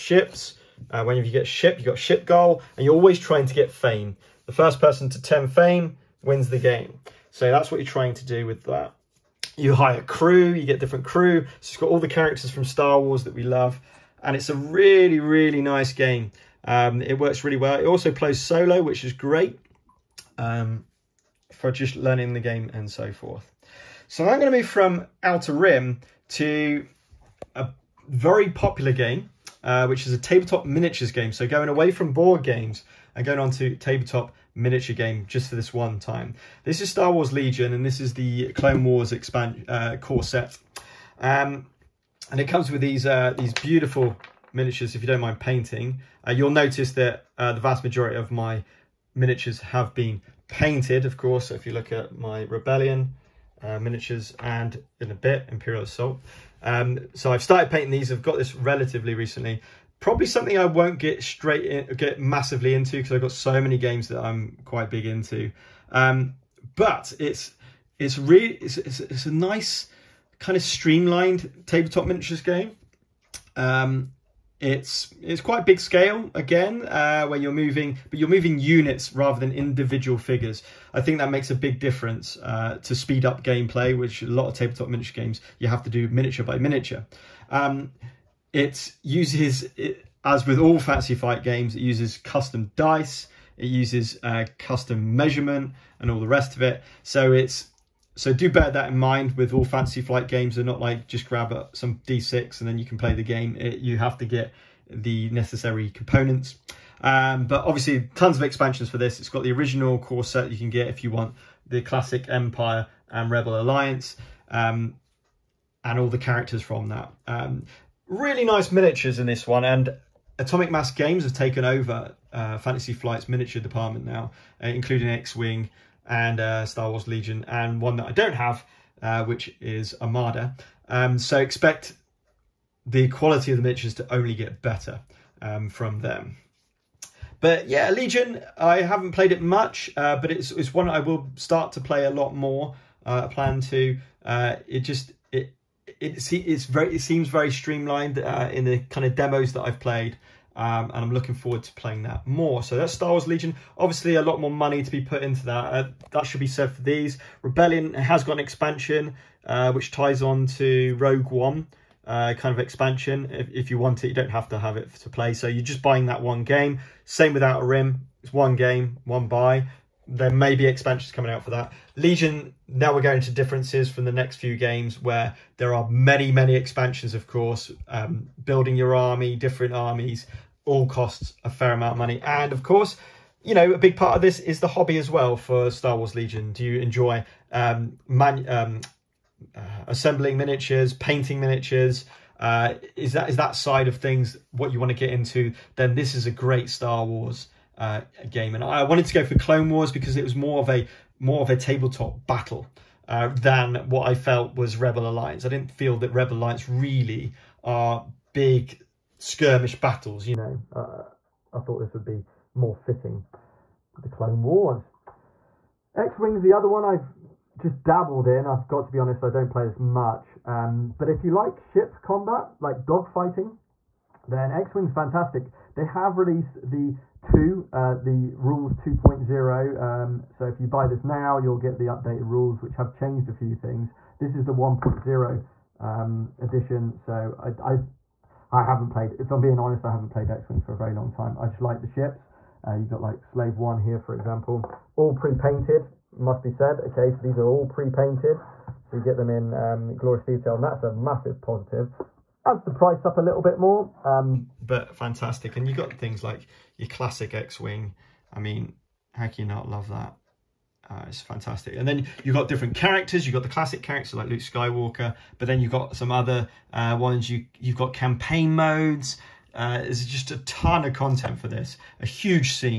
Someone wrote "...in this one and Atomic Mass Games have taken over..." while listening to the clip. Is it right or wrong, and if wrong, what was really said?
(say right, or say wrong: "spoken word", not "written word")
right.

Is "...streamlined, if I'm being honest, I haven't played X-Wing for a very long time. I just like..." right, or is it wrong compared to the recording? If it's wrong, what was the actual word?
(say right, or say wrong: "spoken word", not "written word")
wrong: "played", not "streamlined".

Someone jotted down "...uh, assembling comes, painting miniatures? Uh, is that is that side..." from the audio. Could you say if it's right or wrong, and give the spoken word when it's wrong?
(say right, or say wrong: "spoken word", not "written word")
wrong: "miniatures", not "comes".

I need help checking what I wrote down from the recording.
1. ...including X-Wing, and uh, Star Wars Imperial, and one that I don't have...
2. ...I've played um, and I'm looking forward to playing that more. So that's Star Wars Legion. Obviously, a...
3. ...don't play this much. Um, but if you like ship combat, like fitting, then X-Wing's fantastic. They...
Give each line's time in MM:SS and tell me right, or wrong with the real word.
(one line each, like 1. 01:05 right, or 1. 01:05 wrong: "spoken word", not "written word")
1. 02:04 wrong: "Legion", not "Imperial"
2. 02:29 right
3. 03:39 wrong: "dogfighting", not "fitting".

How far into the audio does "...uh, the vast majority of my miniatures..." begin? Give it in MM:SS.
00:47.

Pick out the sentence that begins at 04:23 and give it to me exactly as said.
You've got the classic characters like Luke Skywalker, but then you've got some other uh, ones.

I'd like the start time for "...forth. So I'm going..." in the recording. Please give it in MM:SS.
00:23.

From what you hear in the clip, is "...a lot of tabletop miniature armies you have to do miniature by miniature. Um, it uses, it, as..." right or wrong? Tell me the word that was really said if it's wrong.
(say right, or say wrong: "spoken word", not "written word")
wrong: "games", not "armies".